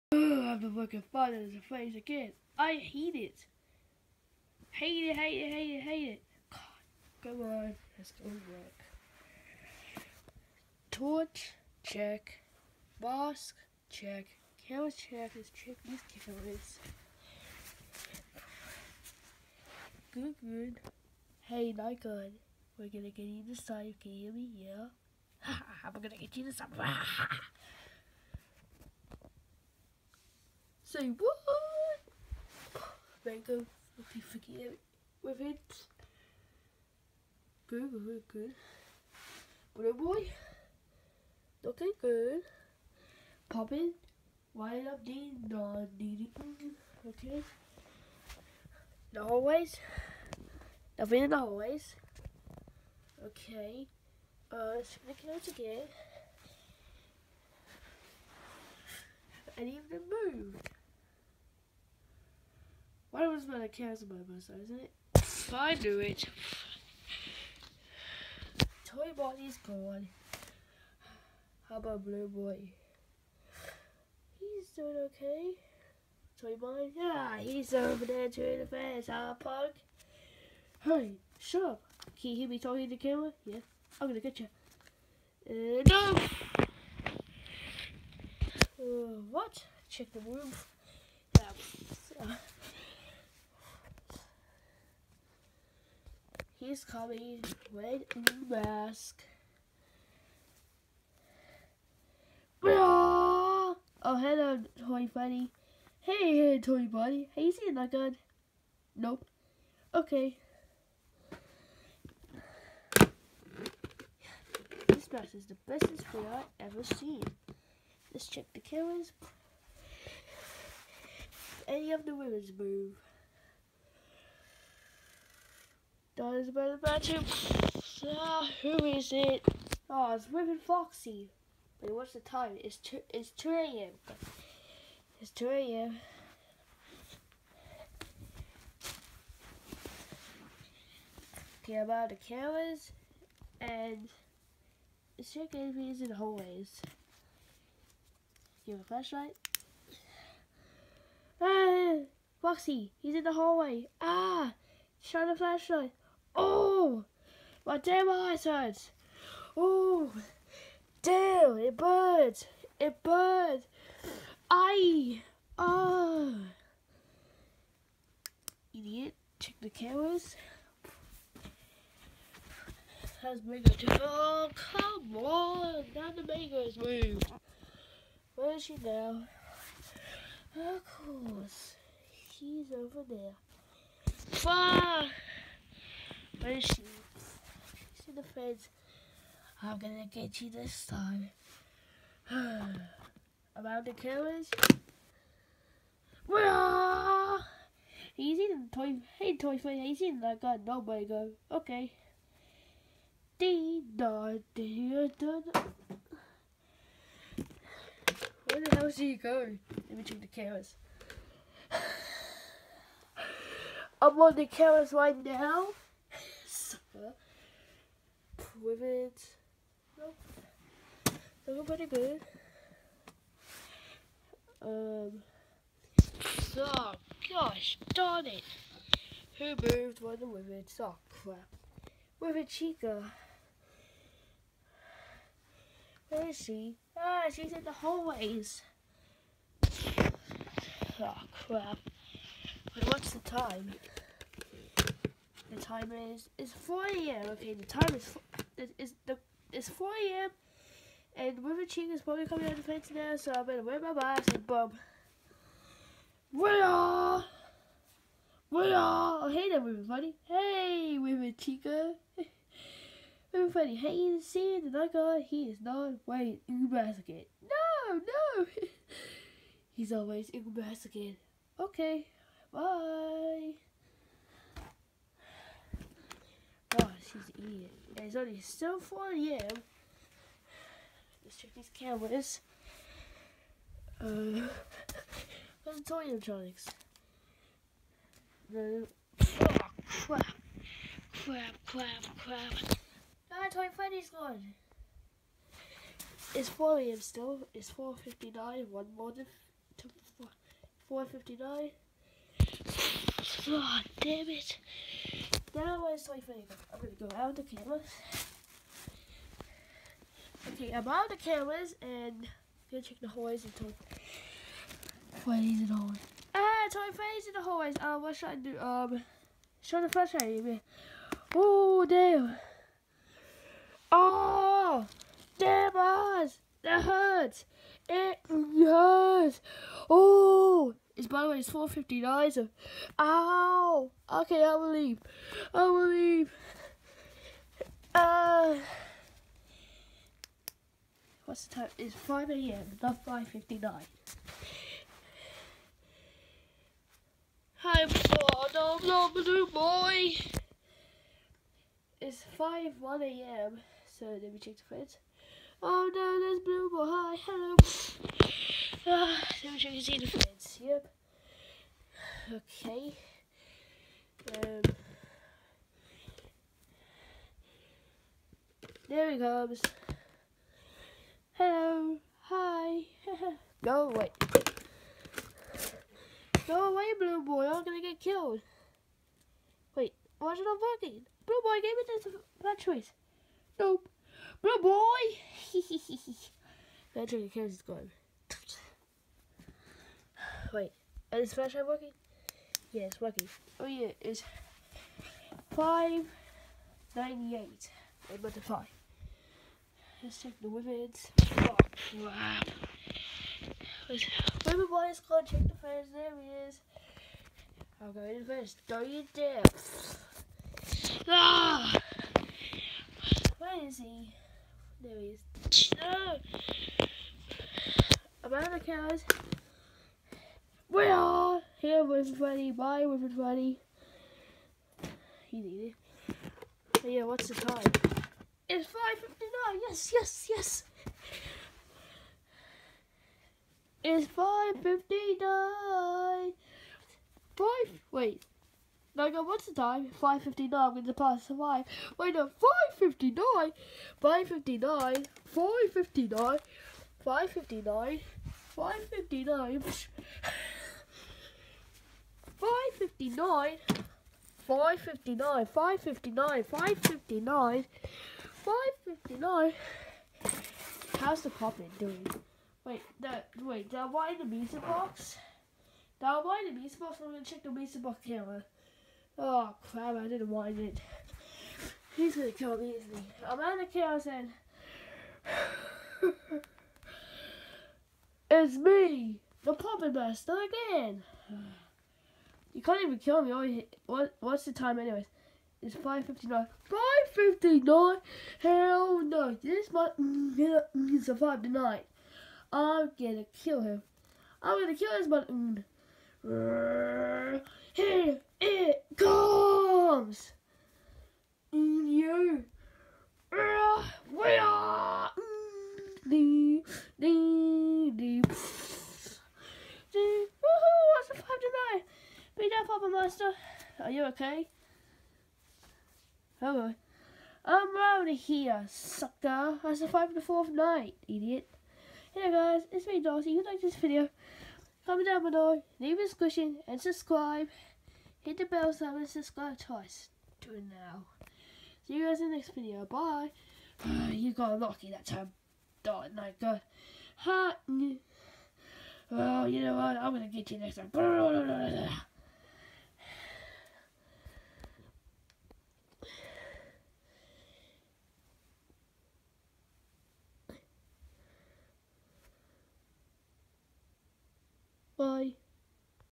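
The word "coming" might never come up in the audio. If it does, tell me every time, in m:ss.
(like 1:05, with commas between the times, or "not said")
1:36, 4:12.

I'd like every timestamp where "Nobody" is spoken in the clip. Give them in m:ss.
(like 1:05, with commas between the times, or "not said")
3:20.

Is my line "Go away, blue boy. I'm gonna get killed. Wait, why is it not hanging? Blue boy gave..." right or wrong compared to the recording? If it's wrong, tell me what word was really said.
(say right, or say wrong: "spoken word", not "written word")
wrong: "working", not "hanging".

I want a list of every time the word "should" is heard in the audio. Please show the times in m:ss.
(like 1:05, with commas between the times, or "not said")
5:18.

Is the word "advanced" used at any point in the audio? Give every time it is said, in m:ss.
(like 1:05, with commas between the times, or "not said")
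not said.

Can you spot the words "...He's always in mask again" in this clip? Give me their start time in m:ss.
4:29.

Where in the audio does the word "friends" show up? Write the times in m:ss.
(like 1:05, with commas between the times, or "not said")
5:54, 6:00.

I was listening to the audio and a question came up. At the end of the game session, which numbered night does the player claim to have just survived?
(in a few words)
fourth.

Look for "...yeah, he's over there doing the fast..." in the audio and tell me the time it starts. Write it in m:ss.
1:16.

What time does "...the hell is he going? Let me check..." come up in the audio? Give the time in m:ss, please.
3:28.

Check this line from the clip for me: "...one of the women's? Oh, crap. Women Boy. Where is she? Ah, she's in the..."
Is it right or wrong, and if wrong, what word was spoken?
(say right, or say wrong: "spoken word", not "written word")
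wrong: "Chica", not "Boy".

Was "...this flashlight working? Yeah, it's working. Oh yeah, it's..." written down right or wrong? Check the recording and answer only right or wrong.
right.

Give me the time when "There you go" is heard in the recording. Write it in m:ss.
0:33.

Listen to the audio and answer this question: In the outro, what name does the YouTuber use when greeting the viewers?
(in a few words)
Darcy.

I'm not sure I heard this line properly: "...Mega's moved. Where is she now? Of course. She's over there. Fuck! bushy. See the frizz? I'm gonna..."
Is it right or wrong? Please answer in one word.
right.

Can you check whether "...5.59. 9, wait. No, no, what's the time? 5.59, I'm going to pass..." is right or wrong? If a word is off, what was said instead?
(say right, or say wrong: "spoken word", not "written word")
wrong: "5", not "9".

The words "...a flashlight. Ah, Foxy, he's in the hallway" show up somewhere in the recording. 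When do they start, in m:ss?
2:28.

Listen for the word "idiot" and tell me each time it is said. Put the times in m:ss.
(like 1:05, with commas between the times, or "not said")
2:48, 8:41.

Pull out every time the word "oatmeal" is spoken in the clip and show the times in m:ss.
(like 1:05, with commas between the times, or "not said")
not said.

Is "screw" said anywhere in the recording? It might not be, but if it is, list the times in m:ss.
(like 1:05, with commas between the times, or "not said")
not said.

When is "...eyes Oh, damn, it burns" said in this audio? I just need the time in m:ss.
2:38.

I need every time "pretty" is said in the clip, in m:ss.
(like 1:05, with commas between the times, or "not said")
3:41.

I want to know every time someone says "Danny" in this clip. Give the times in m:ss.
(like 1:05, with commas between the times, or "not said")
not said.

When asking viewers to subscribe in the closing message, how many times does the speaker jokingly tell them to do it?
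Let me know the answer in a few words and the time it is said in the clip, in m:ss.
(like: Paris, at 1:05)
twice, at 8:49.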